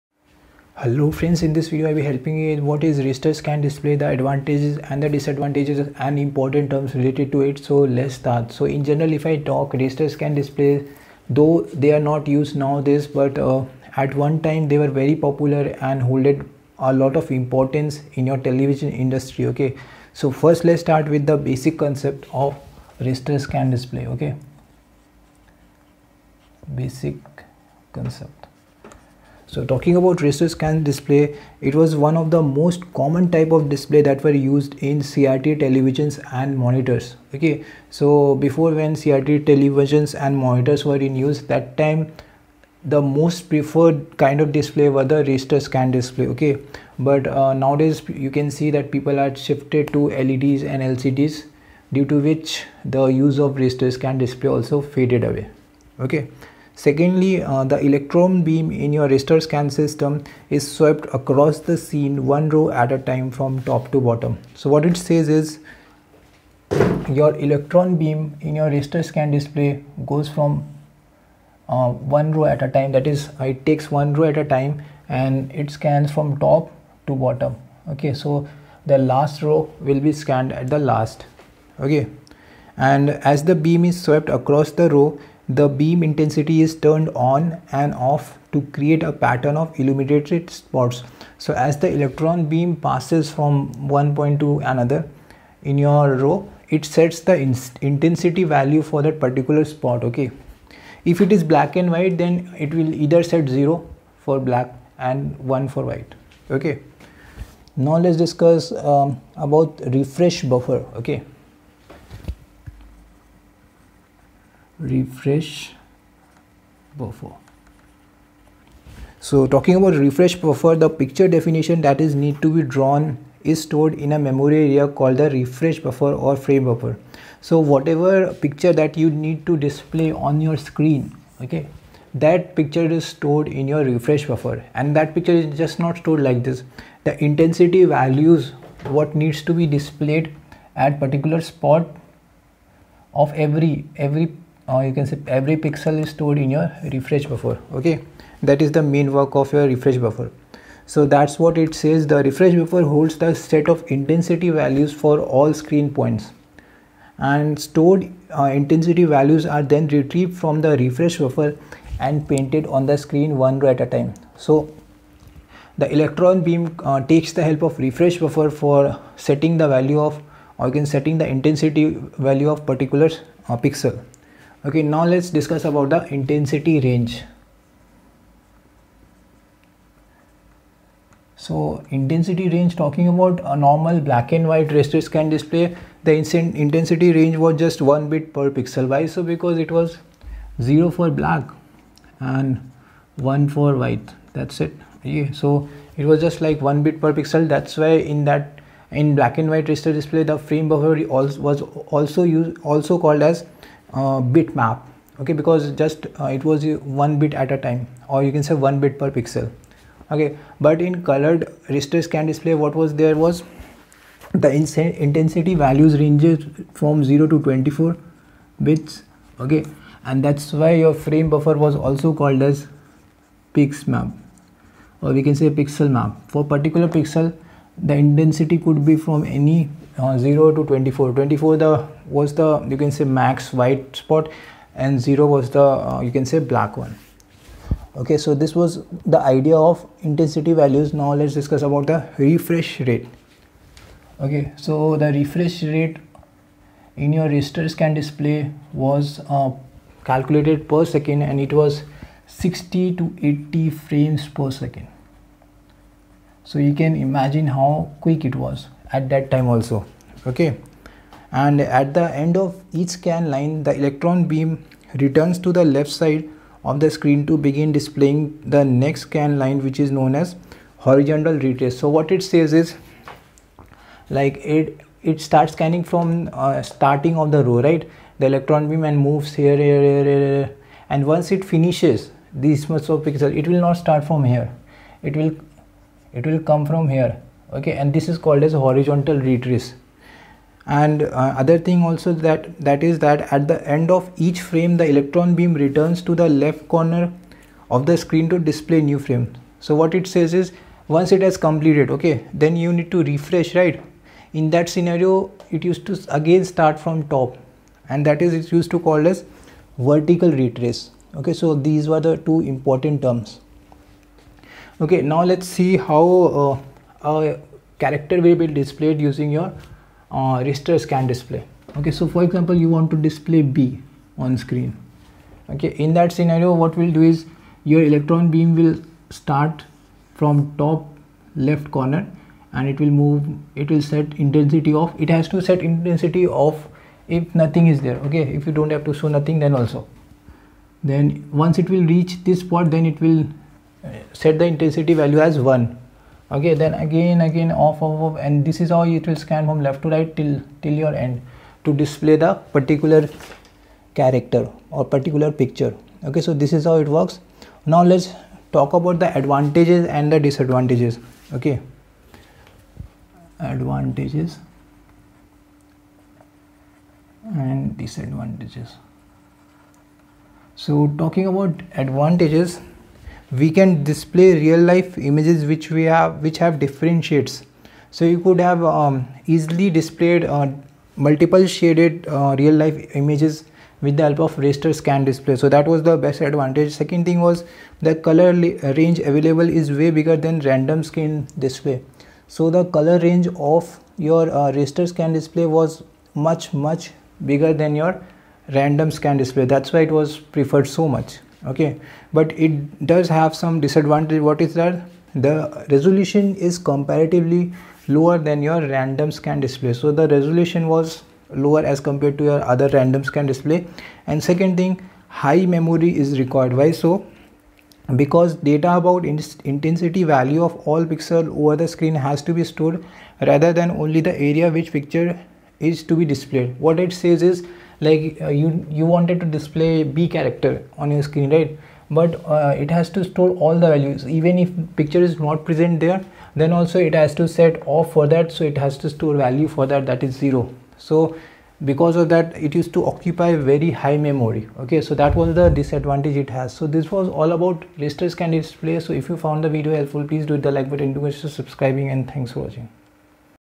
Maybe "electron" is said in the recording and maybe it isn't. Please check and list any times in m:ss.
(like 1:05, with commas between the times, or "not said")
0:57, 1:07, 1:31, 2:45, 4:23, 4:38, 4:54, 5:27.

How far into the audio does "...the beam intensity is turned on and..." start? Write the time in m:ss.
1:25.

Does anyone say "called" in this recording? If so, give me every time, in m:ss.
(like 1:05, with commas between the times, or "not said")
2:04, 3:23, 3:42, 4:48, 5:08.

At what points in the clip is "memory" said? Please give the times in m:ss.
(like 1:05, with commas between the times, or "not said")
2:04, 6:55, 7:24.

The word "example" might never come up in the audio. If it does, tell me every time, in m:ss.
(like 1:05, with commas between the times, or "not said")
5:22.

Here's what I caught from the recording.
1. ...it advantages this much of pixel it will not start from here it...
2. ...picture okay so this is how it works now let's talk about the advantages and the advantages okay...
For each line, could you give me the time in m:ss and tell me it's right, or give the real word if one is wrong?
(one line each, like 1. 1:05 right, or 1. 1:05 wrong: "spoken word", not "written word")
1. 4:41 wrong: "finishes", not "advantages"
2. 5:55 wrong: "disadvantages", not "advantages".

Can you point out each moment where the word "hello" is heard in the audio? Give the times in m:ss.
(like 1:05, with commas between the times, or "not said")
0:00.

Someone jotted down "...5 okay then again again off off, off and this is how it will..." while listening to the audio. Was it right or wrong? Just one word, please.
wrong.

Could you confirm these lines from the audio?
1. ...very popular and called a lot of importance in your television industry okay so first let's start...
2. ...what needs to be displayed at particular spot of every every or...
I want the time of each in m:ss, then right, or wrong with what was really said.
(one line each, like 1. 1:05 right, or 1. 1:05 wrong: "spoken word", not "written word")
1. 0:14 wrong: "holded", not "called"
2. 2:18 right.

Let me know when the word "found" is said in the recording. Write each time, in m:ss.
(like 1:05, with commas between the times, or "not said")
7:29.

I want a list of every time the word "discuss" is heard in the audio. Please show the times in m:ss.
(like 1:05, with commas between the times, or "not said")
1:48, 2:55, 4:01.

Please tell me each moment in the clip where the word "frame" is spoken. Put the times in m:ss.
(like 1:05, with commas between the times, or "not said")
2:06, 3:20, 3:40, 4:13, 4:54, 4:58.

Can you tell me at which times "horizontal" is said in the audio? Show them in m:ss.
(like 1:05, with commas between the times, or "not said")
4:30, 4:48.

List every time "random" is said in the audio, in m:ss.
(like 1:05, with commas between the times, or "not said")
6:30, 6:38, 6:48, 6:52.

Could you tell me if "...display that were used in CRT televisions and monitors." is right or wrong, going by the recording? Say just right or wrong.
right.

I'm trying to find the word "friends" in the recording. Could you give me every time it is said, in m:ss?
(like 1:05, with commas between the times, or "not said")
0:01.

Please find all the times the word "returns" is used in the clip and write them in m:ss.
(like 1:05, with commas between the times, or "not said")
4:24, 4:55.